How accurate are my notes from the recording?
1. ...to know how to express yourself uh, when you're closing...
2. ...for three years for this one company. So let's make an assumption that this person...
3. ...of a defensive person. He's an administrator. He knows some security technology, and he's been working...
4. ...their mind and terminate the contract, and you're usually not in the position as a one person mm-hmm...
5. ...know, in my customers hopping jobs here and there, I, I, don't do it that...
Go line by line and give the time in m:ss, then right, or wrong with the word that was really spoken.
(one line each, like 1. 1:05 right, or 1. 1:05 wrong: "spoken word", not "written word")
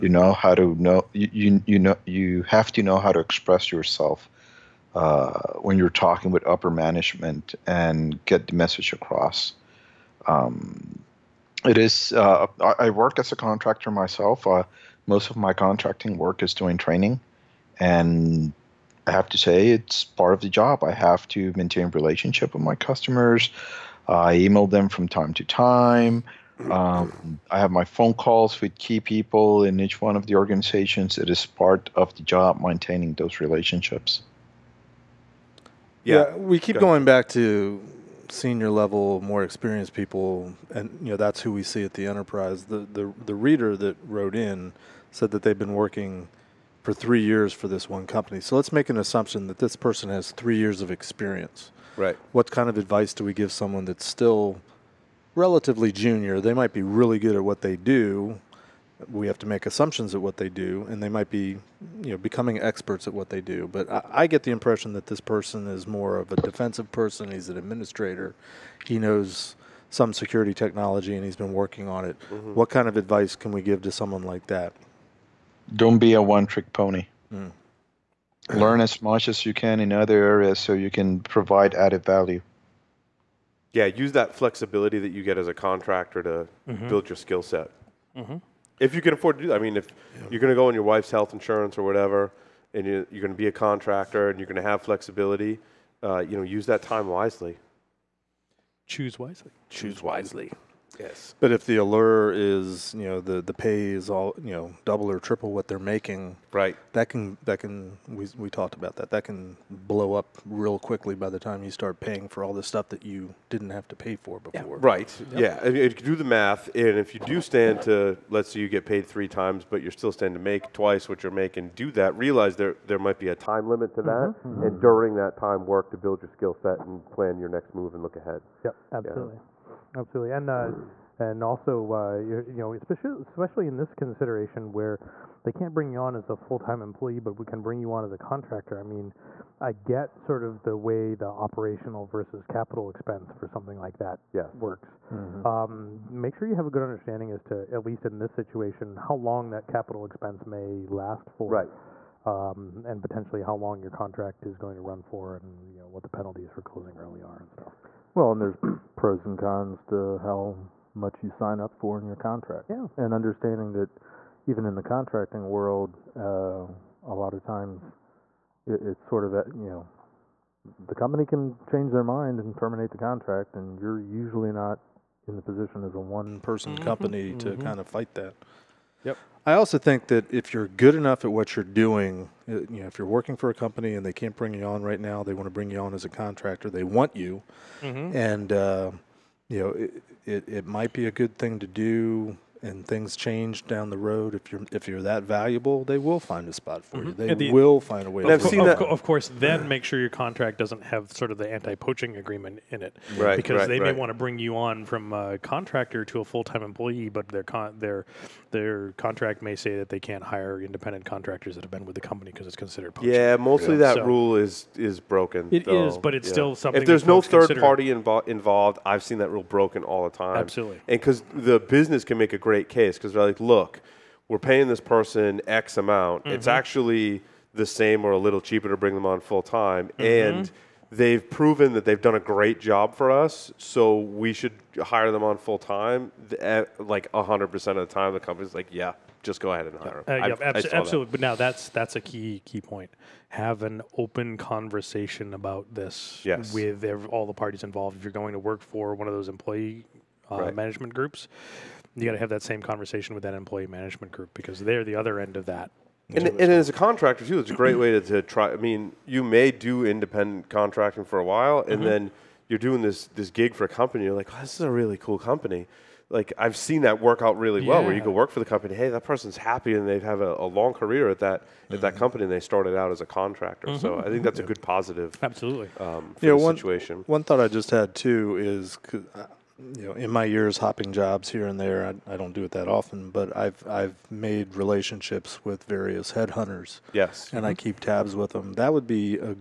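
1. 0:02 wrong: "talking", not "closing"
2. 0:46 right
3. 1:06 right
4. 2:51 right
5. 4:39 wrong: "years", not "customers".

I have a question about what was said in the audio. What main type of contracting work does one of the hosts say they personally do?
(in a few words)
Training.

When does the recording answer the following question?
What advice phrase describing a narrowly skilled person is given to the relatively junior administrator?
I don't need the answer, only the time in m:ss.
1:15.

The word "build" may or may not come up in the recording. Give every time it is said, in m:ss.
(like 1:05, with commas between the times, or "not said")
1:26, 2:05.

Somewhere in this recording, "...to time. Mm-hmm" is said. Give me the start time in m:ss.
0:25.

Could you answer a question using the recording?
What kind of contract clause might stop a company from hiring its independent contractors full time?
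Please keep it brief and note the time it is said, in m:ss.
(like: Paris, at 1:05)
Anti-poaching agreement, at 3:21.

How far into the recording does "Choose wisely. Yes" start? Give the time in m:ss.
1:39.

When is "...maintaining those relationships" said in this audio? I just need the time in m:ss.
0:32.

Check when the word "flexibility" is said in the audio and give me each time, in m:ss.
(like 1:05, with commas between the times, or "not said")
1:24, 1:34.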